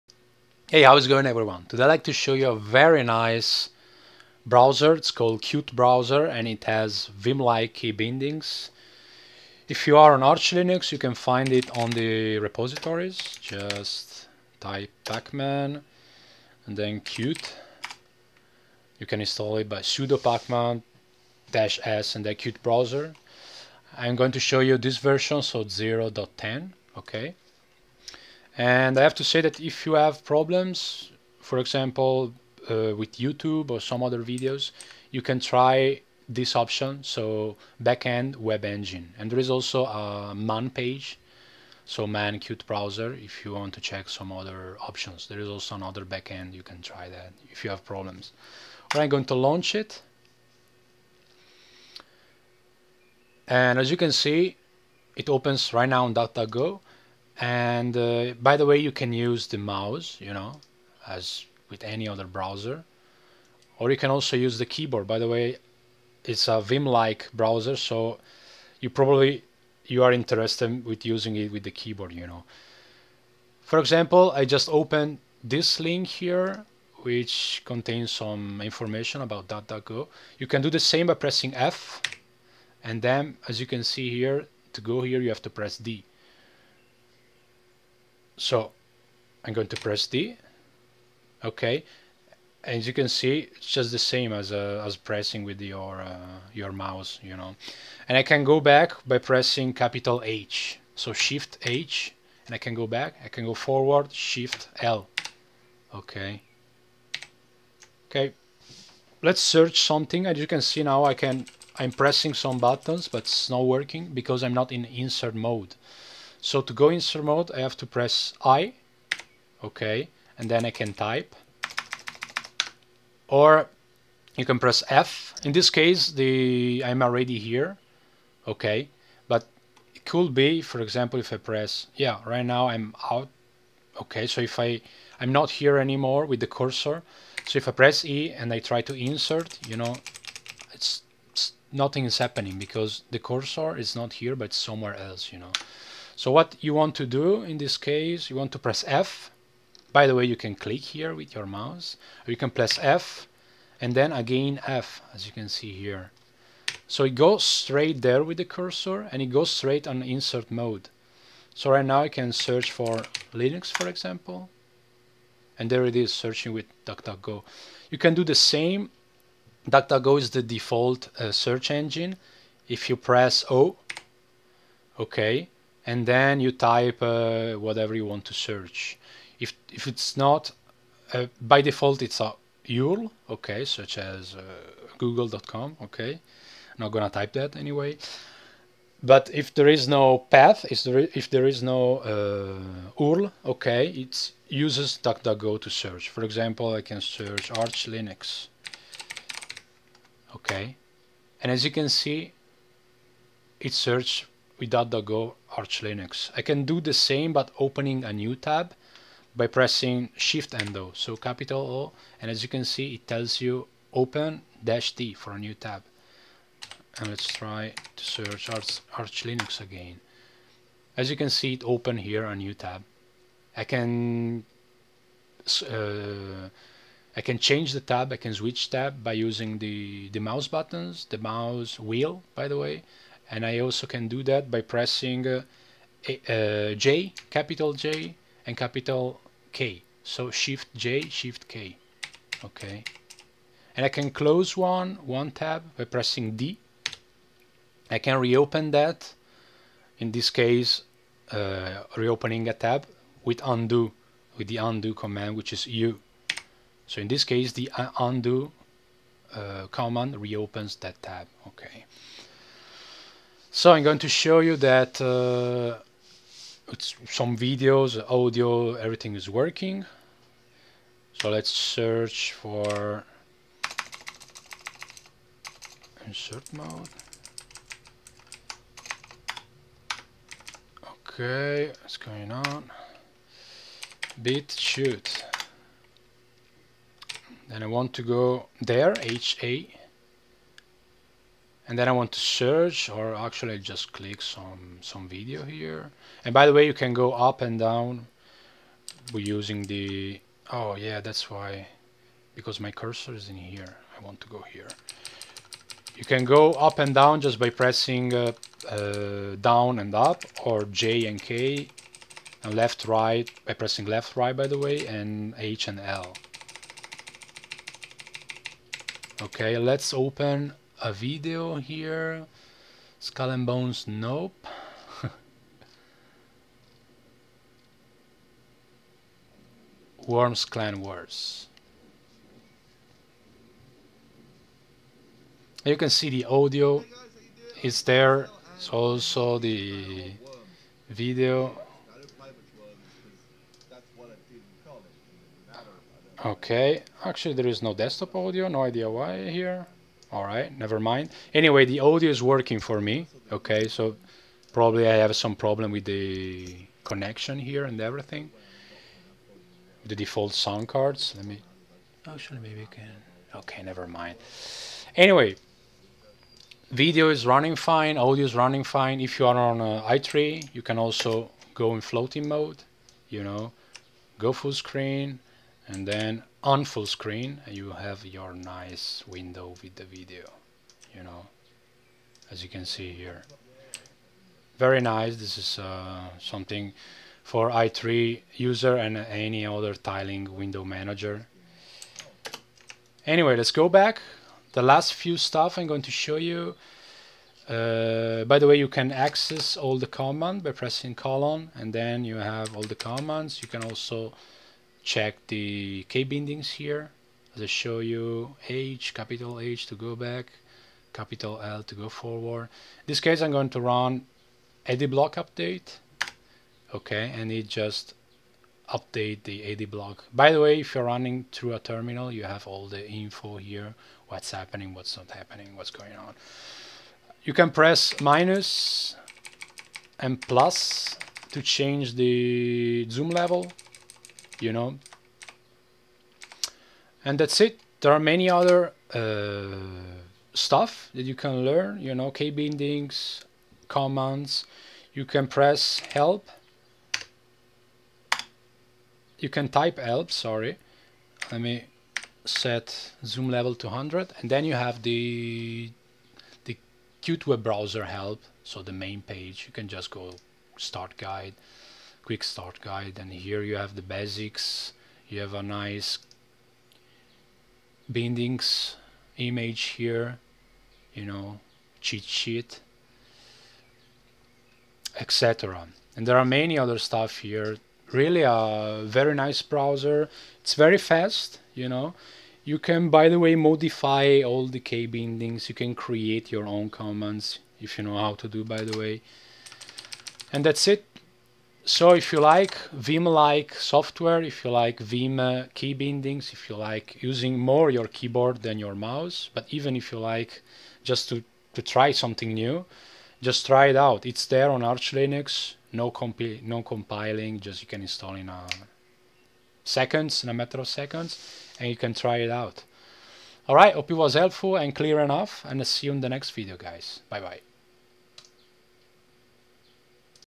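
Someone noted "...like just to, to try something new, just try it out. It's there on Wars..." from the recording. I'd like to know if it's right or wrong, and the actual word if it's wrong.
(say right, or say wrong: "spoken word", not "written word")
wrong: "Arch", not "Wars".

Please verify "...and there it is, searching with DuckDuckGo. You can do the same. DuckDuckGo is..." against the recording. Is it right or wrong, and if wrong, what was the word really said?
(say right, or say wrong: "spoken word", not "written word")
right.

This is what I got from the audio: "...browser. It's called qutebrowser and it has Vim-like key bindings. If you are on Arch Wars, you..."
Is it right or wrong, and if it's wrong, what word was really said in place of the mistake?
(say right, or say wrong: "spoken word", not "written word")
wrong: "Linux", not "Wars".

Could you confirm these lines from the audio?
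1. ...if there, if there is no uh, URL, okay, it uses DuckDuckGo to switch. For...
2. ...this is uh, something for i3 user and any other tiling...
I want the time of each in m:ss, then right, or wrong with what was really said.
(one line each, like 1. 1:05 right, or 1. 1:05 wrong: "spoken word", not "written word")
1. 3:10 wrong: "search", not "switch"
2. 6:25 right.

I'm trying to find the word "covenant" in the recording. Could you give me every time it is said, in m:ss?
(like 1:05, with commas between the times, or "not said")
not said.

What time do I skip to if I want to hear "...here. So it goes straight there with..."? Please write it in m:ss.
2:35.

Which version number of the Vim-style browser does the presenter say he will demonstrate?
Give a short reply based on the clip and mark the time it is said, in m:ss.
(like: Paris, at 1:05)
0.10, at 0:25.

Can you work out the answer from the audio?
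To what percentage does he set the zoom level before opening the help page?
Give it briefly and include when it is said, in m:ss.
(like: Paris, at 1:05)
100, at 7:33.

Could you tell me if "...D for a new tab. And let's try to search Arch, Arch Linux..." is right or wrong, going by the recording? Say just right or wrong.
right.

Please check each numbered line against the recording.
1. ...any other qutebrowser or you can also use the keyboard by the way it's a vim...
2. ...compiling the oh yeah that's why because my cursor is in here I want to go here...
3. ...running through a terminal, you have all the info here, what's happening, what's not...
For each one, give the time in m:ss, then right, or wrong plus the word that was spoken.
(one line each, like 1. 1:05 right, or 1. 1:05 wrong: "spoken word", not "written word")
1. 1:01 wrong: "browser", not "qutebrowser"
2. 4:59 wrong: "using", not "compiling"
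3. 7:00 right.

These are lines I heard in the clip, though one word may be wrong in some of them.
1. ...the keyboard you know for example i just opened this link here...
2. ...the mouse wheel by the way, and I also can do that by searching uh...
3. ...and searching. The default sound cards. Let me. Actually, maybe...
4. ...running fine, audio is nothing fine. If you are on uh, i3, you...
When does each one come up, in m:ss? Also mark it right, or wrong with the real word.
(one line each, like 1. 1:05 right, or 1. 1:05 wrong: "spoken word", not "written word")
1. 1:11 right
2. 3:51 wrong: "pressing", not "searching"
3. 5:57 wrong: "everything", not "searching"
4. 6:07 wrong: "running", not "nothing".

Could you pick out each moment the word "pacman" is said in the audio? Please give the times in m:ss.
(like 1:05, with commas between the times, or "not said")
0:15, 0:20.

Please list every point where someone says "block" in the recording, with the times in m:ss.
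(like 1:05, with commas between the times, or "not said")
6:54, 6:59.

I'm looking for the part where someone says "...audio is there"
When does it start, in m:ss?
5:36.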